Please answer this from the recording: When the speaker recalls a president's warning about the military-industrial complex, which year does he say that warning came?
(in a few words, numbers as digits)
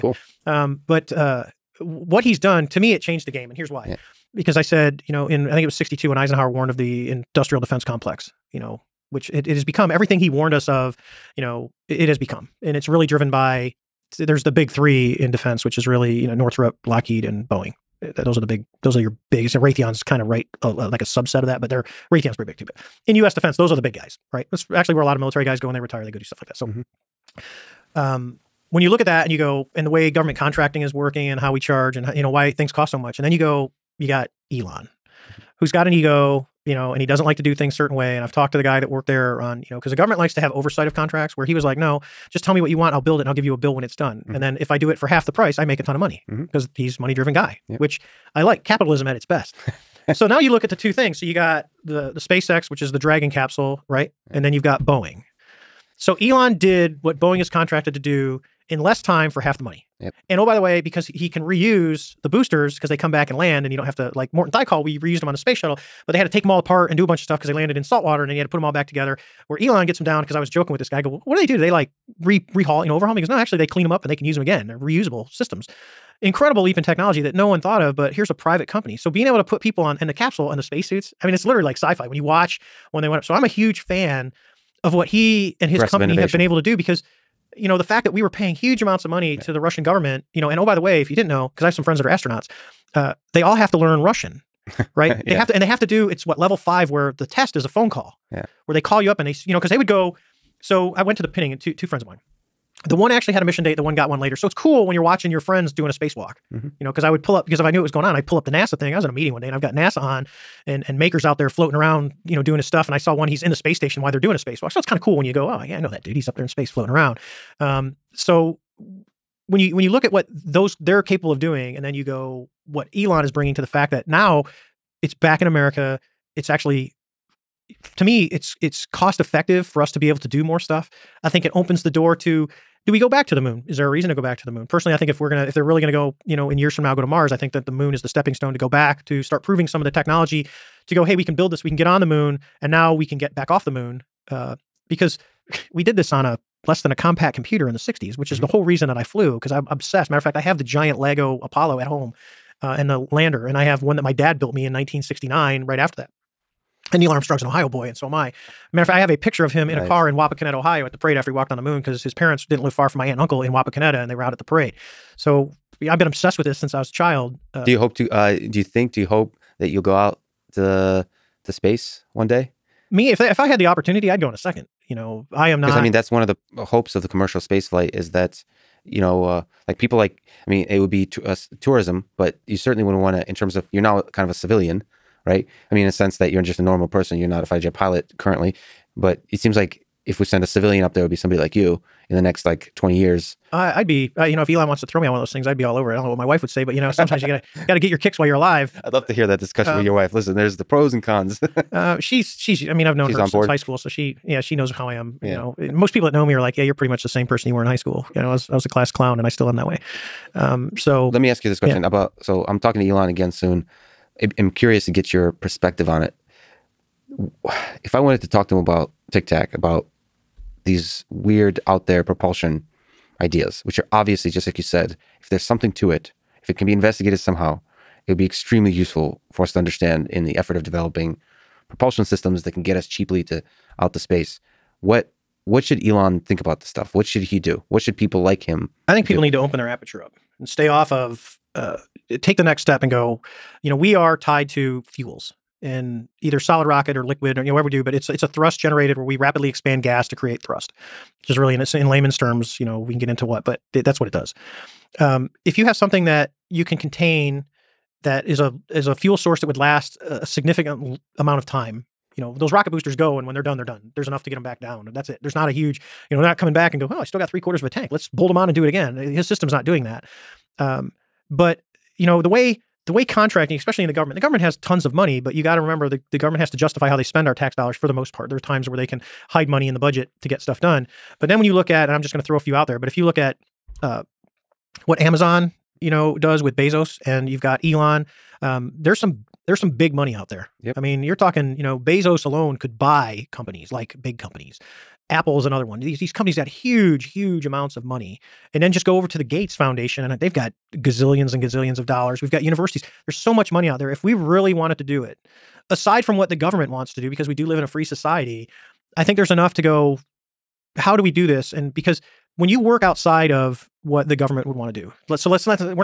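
1962.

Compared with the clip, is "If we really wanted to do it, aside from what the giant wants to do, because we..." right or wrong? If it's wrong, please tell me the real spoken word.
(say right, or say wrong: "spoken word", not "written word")
wrong: "government", not "giant".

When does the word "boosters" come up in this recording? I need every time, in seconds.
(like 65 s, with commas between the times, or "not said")
62 s, 262 s.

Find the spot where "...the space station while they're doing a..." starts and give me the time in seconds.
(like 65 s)
113 s.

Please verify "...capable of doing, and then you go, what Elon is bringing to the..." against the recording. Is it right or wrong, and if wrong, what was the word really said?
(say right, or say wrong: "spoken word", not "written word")
right.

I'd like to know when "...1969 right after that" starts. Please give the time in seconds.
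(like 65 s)
154 s.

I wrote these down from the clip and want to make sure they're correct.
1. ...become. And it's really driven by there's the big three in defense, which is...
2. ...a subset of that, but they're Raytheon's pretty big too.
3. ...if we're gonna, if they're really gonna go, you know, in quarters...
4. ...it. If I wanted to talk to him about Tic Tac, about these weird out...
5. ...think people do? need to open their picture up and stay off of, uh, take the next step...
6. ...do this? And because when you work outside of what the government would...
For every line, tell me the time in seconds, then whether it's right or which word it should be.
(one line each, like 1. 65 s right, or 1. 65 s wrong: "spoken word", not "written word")
1. 12 s right
2. 21 s right
3. 135 s wrong: "years", not "quarters"
4. 216 s right
5. 238 s wrong: "aperture", not "picture"
6. 311 s right.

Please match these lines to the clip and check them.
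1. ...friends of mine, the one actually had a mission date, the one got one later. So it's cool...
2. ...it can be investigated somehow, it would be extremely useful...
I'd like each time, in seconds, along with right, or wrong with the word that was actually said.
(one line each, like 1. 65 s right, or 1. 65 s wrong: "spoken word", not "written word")
1. 101 s right
2. 226 s right.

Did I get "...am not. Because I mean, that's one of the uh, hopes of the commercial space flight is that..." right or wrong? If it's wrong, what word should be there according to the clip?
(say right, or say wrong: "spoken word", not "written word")
right.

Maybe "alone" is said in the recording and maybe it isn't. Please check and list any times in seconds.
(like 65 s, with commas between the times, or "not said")
292 s.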